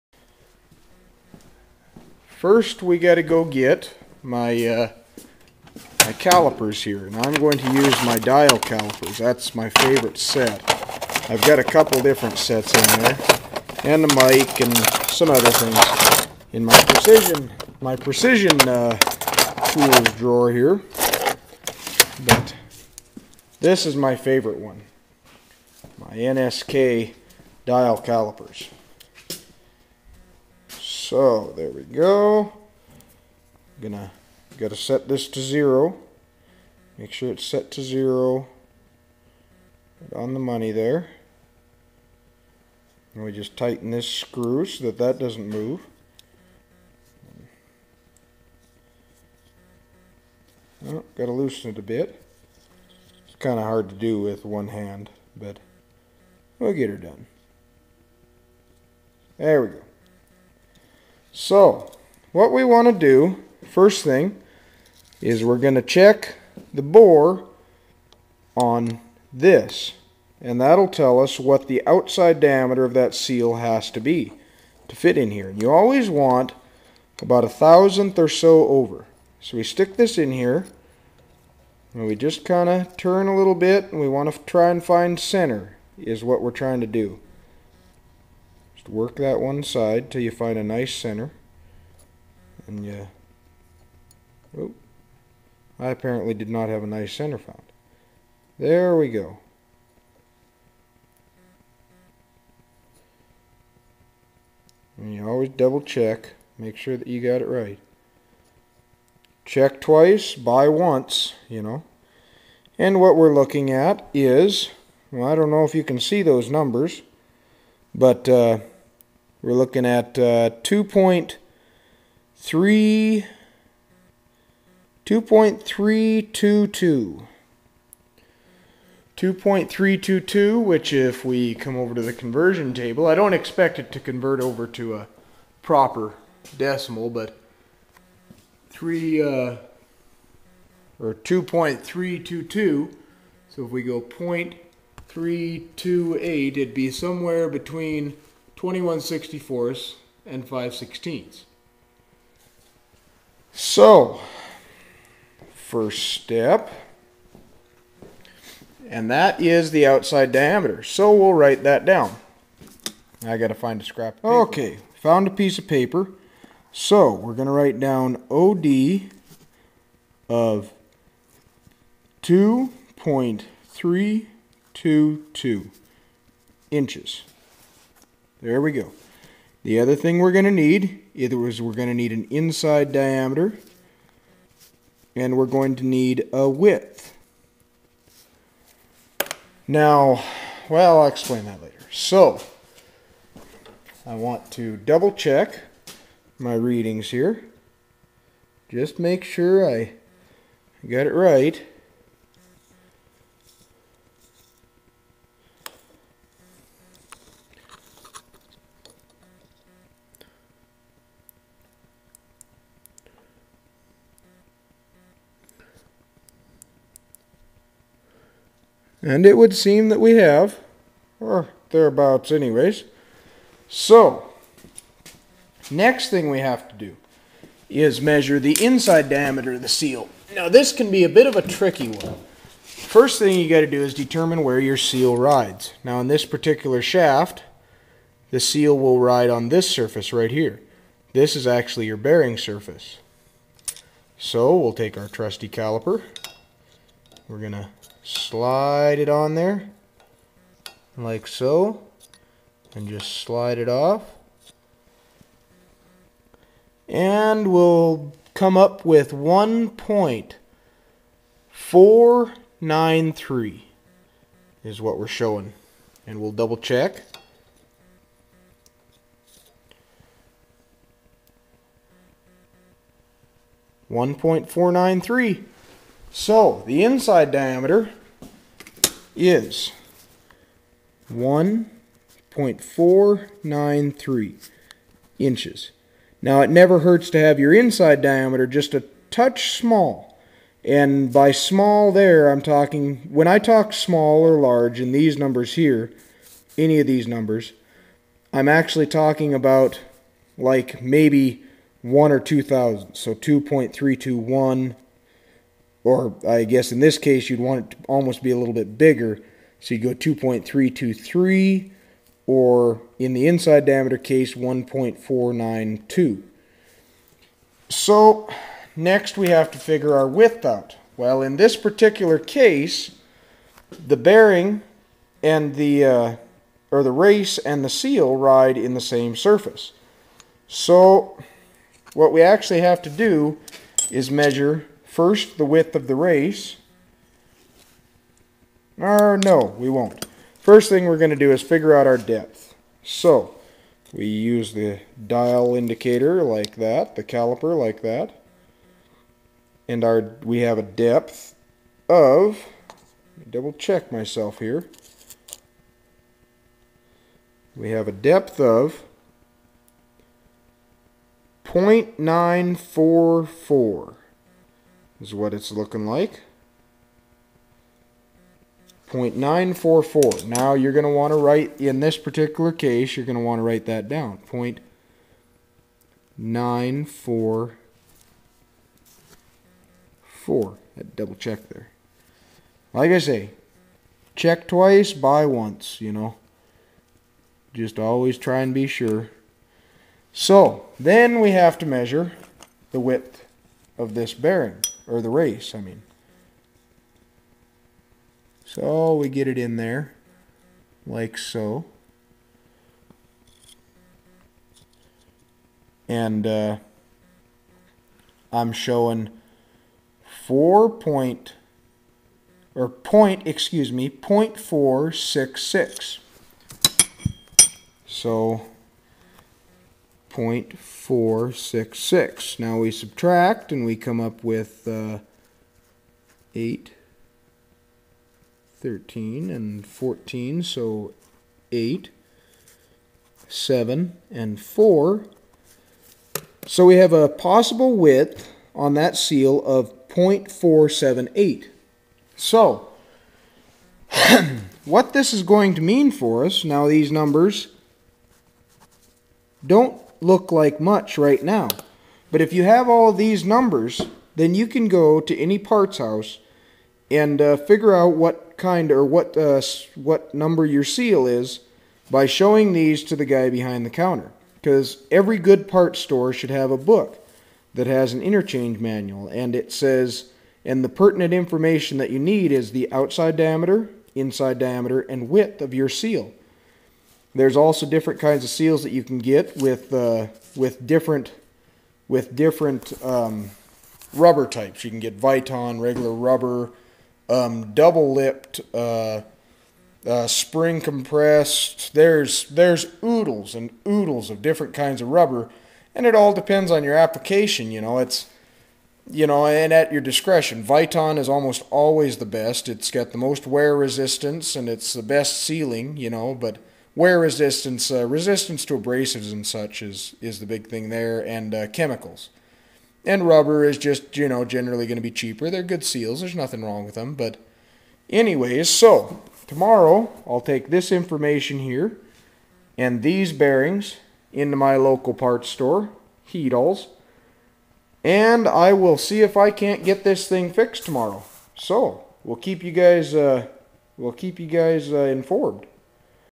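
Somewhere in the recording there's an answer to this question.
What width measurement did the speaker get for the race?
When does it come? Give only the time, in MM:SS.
07:00.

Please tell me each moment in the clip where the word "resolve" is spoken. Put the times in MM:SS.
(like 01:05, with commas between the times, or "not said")
not said.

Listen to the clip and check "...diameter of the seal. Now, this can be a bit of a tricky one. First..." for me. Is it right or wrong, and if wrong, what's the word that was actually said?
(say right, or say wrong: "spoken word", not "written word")
right.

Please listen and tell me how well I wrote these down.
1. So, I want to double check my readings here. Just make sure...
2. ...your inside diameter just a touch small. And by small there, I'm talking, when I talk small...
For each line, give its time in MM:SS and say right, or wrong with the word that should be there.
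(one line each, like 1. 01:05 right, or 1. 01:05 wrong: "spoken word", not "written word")
1. 03:11 right
2. 04:47 right.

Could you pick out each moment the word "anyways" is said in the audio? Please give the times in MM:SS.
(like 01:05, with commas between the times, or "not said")
03:42, 08:37.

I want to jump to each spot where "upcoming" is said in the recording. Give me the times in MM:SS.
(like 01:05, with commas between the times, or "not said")
not said.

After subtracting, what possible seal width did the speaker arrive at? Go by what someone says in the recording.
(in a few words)
0.478.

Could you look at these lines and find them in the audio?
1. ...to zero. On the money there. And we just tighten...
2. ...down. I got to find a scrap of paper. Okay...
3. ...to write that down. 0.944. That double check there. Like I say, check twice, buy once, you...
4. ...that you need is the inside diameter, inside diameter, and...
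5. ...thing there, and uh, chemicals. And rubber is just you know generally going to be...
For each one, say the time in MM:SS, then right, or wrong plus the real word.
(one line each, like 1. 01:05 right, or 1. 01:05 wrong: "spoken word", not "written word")
1. 00:37 right
2. 02:41 right
3. 06:13 right
4. 07:51 wrong: "outside", not "inside"
5. 08:30 right.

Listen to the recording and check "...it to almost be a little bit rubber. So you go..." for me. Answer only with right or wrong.
wrong.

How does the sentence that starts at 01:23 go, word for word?
And we want to try and find center is what we're trying to do.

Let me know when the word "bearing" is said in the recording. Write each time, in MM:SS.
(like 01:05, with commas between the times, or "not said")
04:01, 05:23, 06:34, 08:43.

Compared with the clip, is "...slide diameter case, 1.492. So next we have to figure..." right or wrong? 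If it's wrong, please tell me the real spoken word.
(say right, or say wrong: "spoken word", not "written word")
wrong: "inside", not "slide".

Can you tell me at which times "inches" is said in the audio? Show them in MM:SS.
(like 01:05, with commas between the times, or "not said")
02:56, 04:45.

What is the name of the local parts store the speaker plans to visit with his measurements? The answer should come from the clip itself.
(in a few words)
Heedles.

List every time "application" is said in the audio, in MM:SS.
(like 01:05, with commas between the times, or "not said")
08:16.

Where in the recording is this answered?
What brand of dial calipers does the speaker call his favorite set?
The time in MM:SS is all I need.
00:26.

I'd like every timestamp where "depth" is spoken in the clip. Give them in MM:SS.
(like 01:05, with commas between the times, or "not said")
05:41, 05:50, 05:57.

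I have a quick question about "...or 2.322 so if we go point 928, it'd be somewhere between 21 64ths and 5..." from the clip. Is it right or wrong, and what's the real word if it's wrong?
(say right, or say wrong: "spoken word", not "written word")
wrong: "328", not "928".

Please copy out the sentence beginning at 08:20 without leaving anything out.
Viton is almost always the best.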